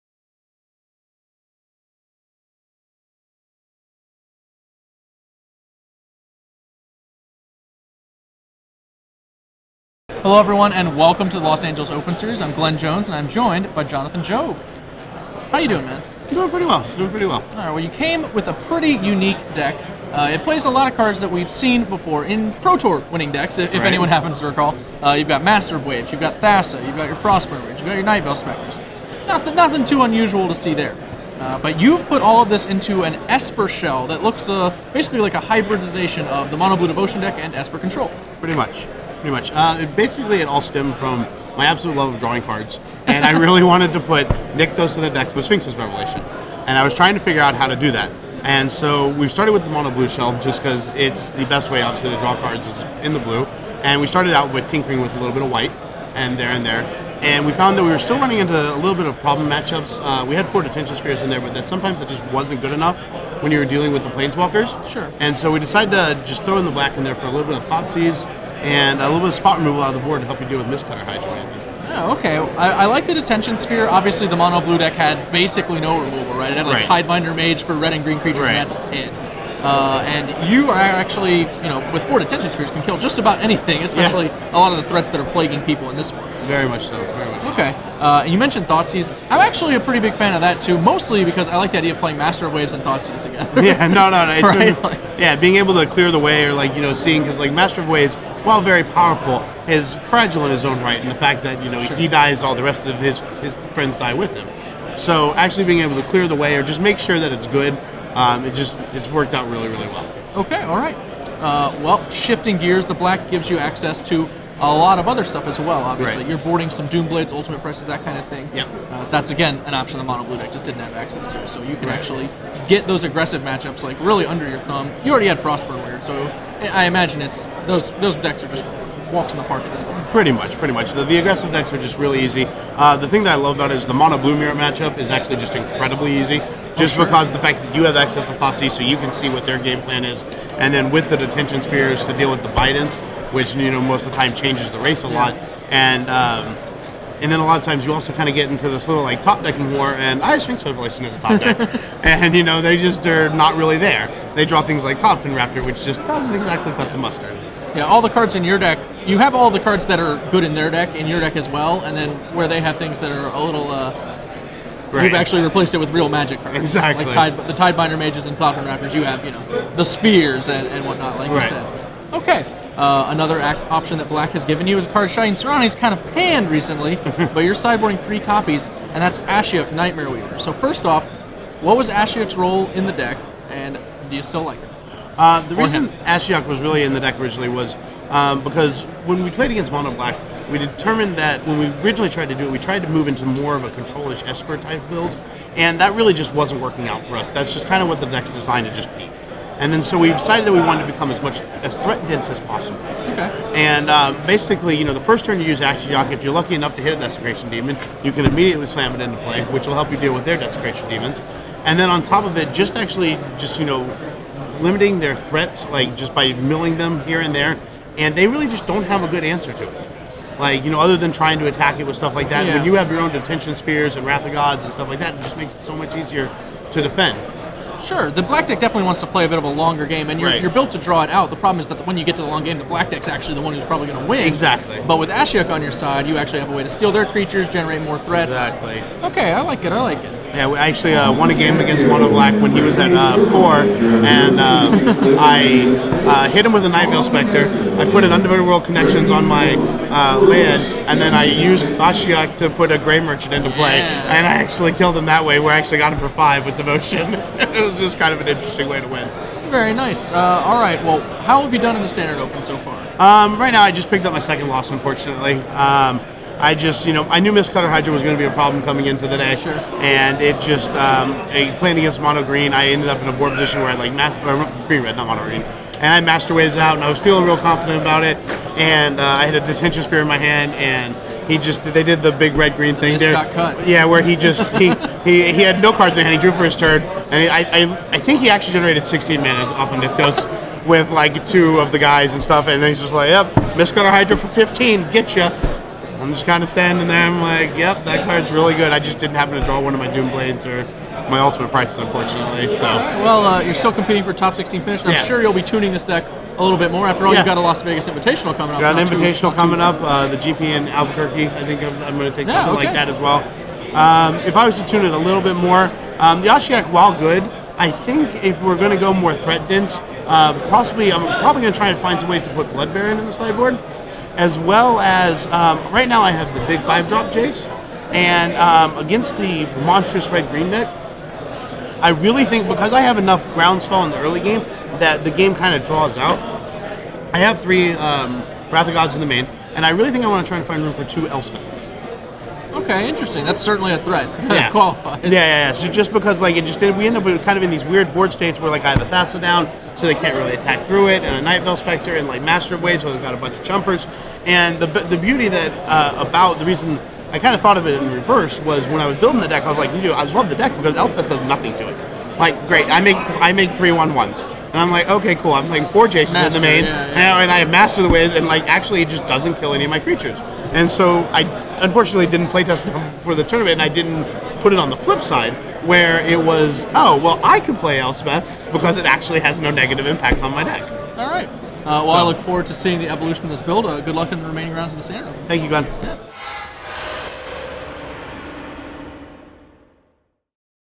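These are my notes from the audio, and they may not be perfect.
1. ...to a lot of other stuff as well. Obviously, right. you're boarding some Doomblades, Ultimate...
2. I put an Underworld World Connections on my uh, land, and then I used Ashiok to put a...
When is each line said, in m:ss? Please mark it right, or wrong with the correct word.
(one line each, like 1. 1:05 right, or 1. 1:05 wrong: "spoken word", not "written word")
1. 1:54 right
2. 4:07 right.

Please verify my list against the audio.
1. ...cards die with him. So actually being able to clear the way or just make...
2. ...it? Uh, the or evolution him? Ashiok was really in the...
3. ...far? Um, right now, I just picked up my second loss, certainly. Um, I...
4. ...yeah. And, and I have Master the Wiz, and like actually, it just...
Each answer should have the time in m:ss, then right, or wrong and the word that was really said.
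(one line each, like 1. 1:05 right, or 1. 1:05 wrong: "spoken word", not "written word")
1. 1:43 wrong: "friends", not "cards"
2. 3:04 wrong: "reason", not "evolution"
3. 4:22 wrong: "unfortunately", not "certainly"
4. 6:06 right.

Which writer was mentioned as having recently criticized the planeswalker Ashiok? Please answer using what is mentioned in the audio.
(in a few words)
Shaheen Soorani.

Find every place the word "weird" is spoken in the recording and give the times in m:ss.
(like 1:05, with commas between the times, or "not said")
2:05, 5:47.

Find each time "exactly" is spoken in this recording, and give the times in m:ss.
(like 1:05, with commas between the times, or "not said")
2:36, 2:46, 3:54, 3:58.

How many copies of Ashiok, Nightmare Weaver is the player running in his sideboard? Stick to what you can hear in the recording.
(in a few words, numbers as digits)
3.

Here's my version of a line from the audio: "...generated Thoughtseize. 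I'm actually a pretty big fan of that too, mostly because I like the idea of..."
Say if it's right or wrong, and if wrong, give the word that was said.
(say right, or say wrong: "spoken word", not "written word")
wrong: "mentioned", not "generated".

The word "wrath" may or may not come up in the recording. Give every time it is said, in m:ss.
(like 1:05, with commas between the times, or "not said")
3:44, 5:38.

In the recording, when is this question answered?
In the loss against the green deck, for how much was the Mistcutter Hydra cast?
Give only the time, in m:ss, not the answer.
4:53.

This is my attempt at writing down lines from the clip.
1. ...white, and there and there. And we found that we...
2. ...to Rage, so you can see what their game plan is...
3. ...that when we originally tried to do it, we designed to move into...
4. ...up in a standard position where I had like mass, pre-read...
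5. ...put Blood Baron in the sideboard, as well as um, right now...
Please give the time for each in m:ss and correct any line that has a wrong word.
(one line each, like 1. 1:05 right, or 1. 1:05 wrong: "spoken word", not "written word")
1. 0:55 right
2. 2:18 wrong: "Thoughtseize", not "Rage"
3. 3:11 wrong: "tried", not "designed"
4. 4:32 wrong: "board", not "standard"
5. 5:22 right.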